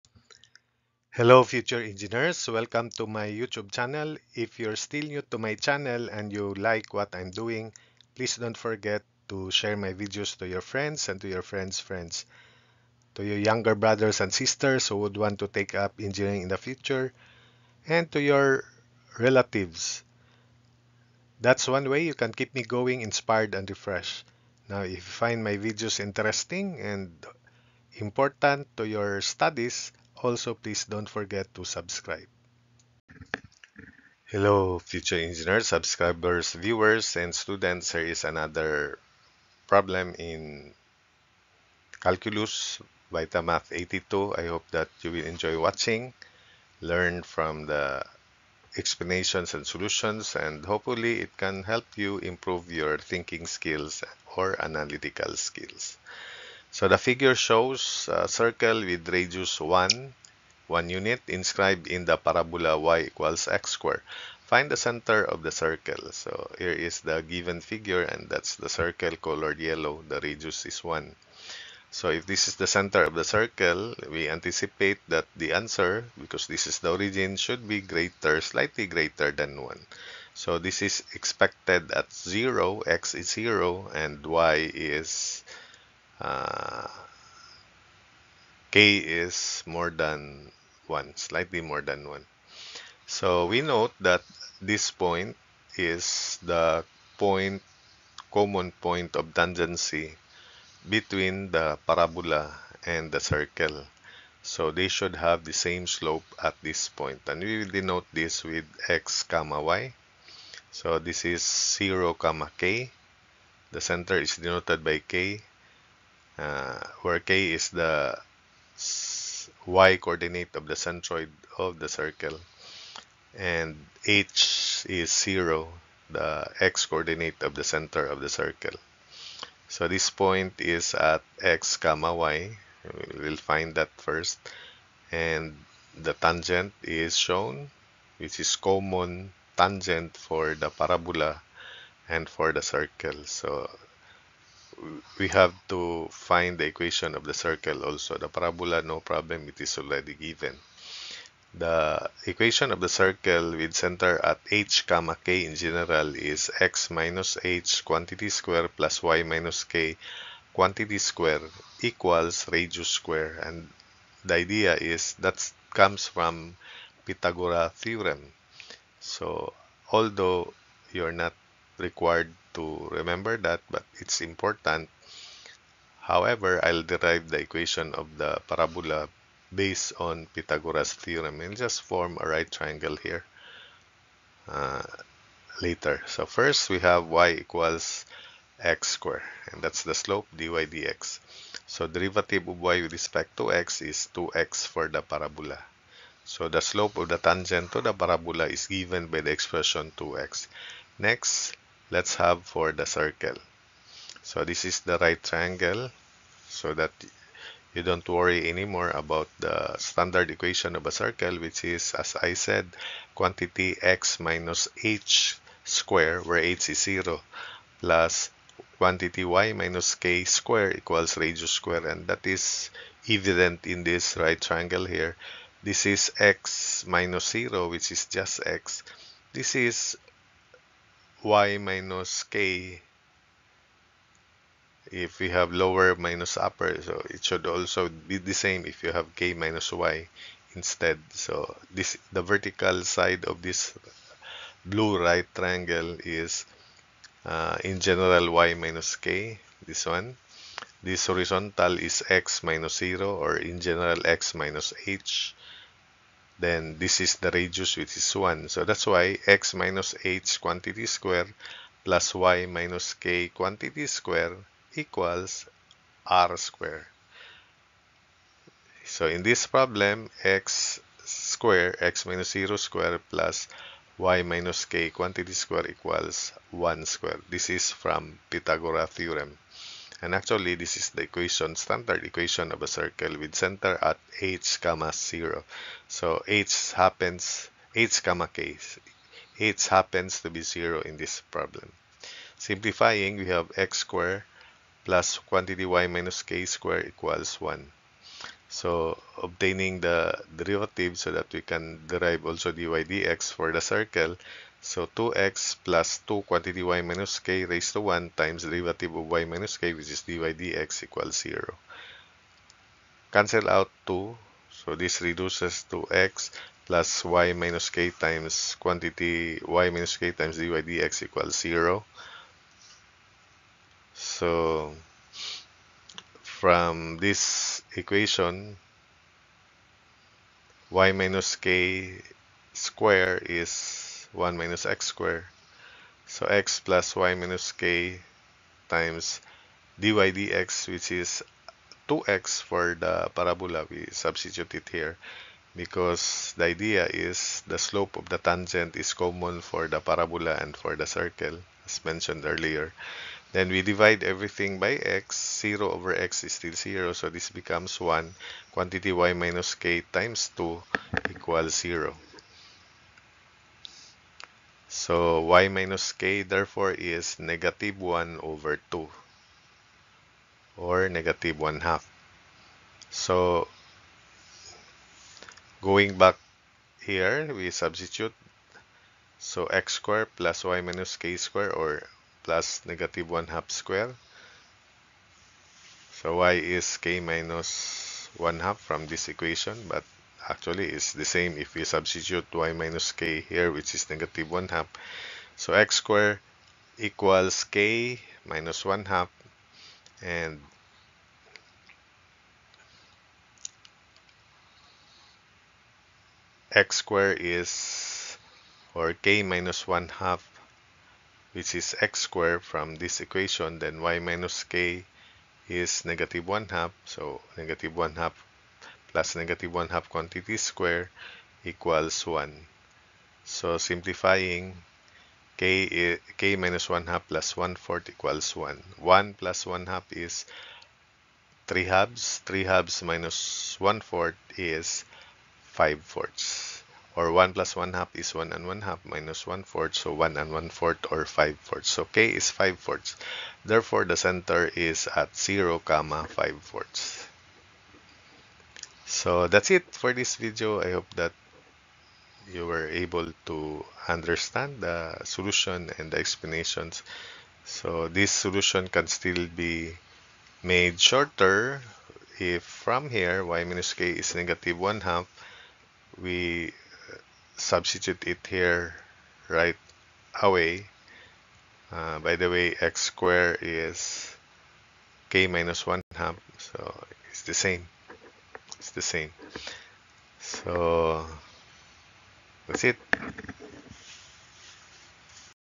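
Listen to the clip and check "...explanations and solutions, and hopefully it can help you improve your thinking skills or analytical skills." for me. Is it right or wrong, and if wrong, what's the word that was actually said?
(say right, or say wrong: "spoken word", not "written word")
right.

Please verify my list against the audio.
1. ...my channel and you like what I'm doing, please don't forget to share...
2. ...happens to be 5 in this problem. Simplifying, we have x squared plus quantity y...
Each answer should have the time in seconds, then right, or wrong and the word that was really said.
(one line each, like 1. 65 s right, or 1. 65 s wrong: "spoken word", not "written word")
1. 5 s right
2. 289 s wrong: "0", not "5".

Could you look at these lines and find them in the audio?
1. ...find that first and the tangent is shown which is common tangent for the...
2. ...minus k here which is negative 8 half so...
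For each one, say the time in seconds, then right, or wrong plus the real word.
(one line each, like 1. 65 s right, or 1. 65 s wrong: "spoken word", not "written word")
1. 133 s right
2. 392 s wrong: "1", not "8".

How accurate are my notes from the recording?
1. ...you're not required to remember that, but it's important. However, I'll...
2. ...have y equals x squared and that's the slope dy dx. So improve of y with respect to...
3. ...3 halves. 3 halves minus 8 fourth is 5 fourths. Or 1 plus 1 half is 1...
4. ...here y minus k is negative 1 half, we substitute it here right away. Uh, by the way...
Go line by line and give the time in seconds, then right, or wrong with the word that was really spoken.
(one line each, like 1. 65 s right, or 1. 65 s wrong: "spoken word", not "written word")
1. 170 s right
2. 186 s wrong: "derivative", not "improve"
3. 431 s wrong: "1", not "8"
4. 462 s right.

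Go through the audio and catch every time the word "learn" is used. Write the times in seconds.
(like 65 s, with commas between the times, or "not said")
46 s.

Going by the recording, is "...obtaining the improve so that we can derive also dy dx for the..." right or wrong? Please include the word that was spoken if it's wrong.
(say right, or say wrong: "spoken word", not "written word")
wrong: "derivative", not "improve".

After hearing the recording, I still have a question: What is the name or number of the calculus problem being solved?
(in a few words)
VitaMath 82.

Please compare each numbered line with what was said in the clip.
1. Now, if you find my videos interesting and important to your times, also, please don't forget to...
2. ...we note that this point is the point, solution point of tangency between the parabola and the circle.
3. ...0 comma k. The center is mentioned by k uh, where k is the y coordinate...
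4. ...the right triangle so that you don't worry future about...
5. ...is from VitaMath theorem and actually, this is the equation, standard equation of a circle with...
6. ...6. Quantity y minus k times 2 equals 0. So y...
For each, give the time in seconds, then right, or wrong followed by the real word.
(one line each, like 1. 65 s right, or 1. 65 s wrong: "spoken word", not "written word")
1. 24 s wrong: "studies", not "times"
2. 93 s wrong: "common", not "solution"
3. 111 s wrong: "denoted", not "mentioned"
4. 204 s wrong: "anymore", not "future"
5. 277 s wrong: "Pythagoras", not "VitaMath"
6. 357 s wrong: "1", not "6".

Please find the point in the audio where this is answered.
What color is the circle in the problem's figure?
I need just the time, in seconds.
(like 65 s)
69 s.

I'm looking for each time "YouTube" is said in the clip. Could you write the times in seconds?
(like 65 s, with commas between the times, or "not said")
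3 s.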